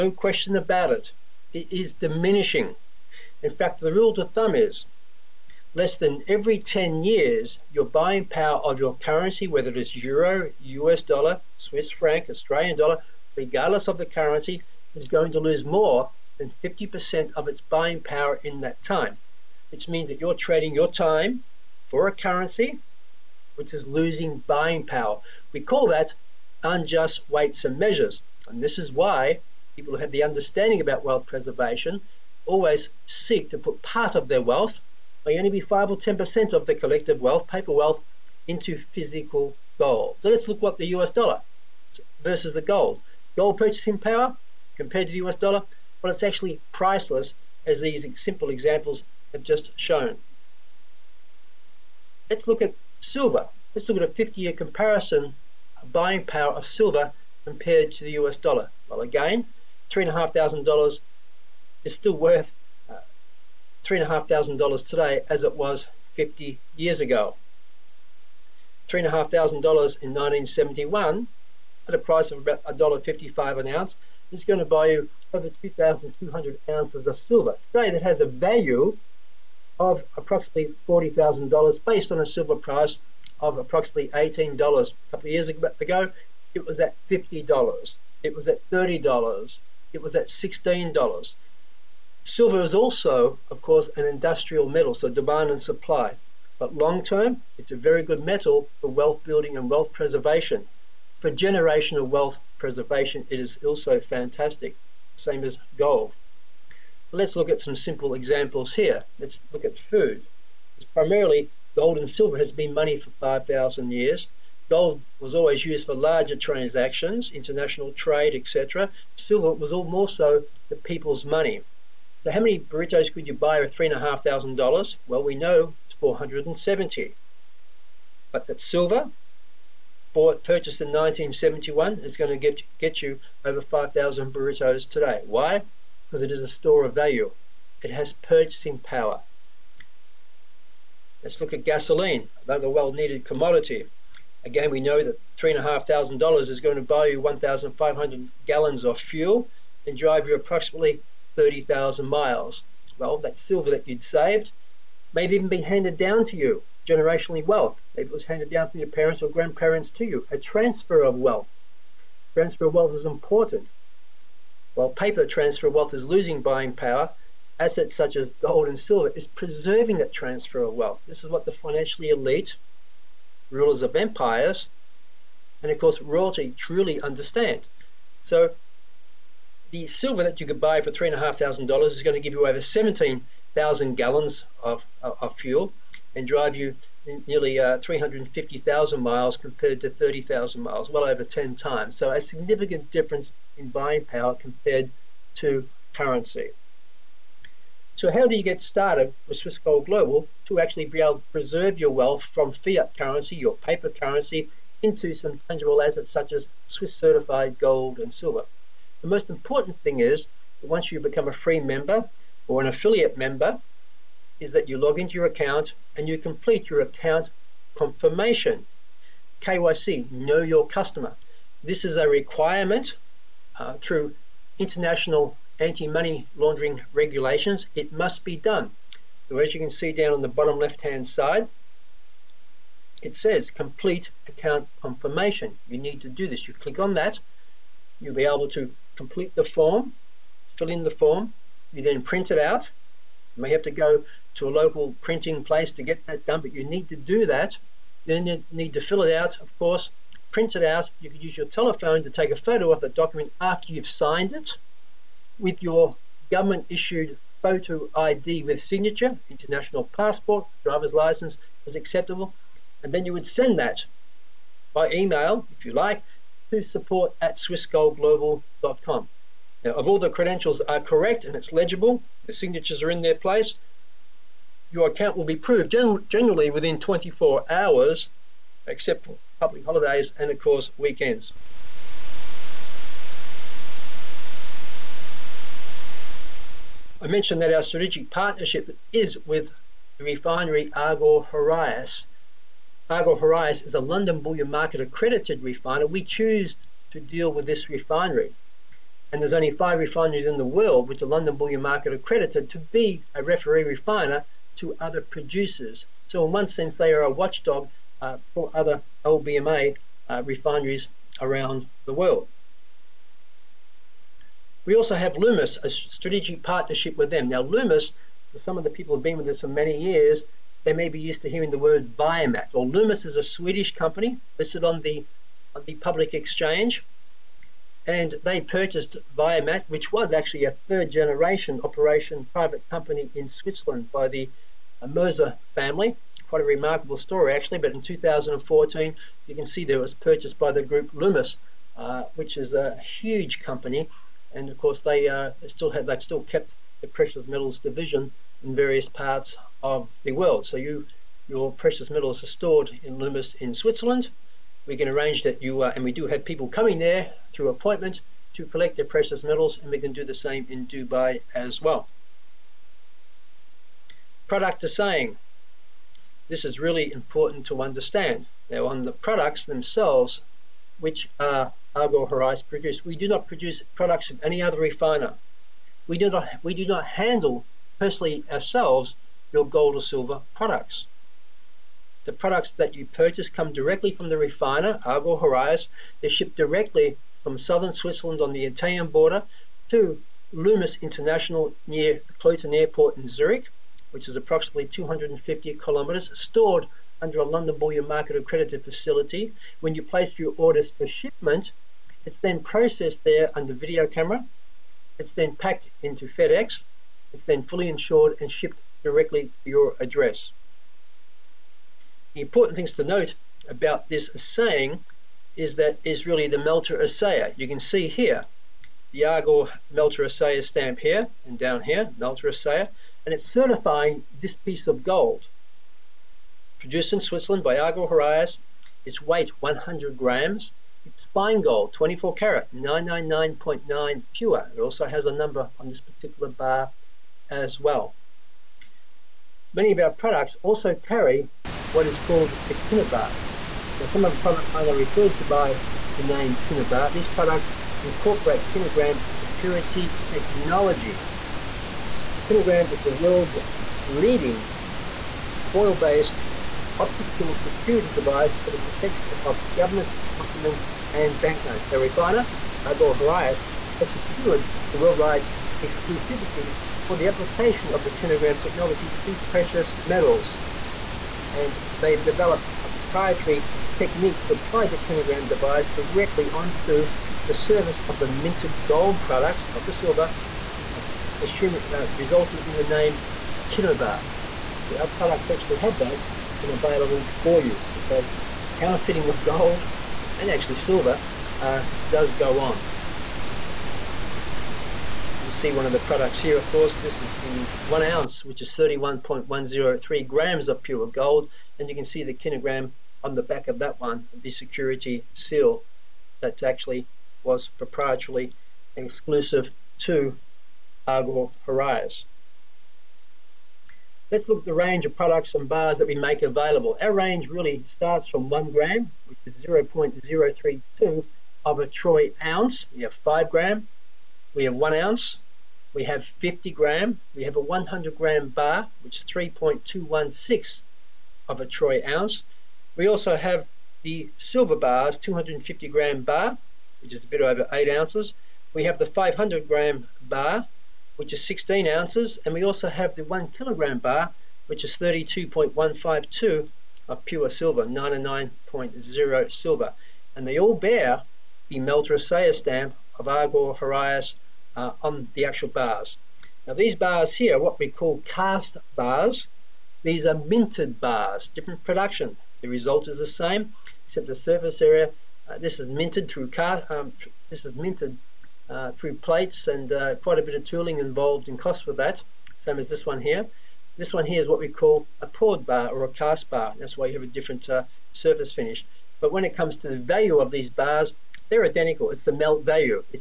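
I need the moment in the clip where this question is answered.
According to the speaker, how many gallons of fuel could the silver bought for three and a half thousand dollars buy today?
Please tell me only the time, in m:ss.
3:02.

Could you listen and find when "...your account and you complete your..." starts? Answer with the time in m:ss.
3:35.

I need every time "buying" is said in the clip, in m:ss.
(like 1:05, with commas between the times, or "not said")
0:07, 0:17, 0:24, 0:55, 2:46, 3:13.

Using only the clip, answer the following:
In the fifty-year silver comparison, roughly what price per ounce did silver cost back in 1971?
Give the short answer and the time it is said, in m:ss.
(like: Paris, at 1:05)
$1.55, at 1:12.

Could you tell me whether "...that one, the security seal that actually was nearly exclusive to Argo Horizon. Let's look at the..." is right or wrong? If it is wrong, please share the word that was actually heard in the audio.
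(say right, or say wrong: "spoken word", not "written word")
wrong: "proprietarily", not "nearly".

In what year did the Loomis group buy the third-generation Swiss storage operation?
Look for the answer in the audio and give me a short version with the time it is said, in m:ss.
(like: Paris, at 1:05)
2014, at 5:37.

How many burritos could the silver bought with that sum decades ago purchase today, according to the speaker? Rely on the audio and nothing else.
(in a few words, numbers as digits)
over 5,000.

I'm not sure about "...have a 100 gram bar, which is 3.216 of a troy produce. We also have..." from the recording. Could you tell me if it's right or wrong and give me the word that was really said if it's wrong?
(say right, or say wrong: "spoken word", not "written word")
wrong: "ounce", not "produce".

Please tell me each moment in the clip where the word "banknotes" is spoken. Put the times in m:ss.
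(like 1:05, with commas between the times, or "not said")
7:41.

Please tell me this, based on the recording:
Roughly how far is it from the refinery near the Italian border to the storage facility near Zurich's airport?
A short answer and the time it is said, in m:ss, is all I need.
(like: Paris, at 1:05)
250 kilometres, at 6:34.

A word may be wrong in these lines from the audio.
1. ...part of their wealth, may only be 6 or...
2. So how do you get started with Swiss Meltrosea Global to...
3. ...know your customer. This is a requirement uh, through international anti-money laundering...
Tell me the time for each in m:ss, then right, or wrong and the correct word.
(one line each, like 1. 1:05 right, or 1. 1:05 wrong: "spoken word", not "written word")
1. 0:33 wrong: "5", not "6"
2. 3:17 wrong: "Gold", not "Meltrosea"
3. 3:40 right.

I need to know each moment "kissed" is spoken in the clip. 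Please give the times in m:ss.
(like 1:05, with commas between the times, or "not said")
not said.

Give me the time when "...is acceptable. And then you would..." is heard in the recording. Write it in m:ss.
4:21.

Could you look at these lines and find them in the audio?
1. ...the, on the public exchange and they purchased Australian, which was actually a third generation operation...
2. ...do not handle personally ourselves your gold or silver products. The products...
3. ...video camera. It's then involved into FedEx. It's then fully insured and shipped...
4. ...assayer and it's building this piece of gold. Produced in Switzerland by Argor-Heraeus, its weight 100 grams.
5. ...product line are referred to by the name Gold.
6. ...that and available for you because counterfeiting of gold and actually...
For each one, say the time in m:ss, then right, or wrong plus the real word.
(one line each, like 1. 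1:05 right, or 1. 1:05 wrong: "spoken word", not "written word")
1. 5:24 wrong: "ViaMat", not "Australian"
2. 6:16 right
3. 6:43 wrong: "packed", not "involved"
4. 7:02 wrong: "certifying", not "building"
5. 7:24 wrong: "Kinebar", not "Gold"
6. 8:05 right.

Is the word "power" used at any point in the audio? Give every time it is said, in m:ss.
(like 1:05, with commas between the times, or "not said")
0:08, 0:18, 0:24, 0:43, 0:56, 2:18, 2:46, 3:14.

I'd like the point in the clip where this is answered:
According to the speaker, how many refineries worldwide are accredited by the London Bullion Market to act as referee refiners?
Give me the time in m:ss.
4:59.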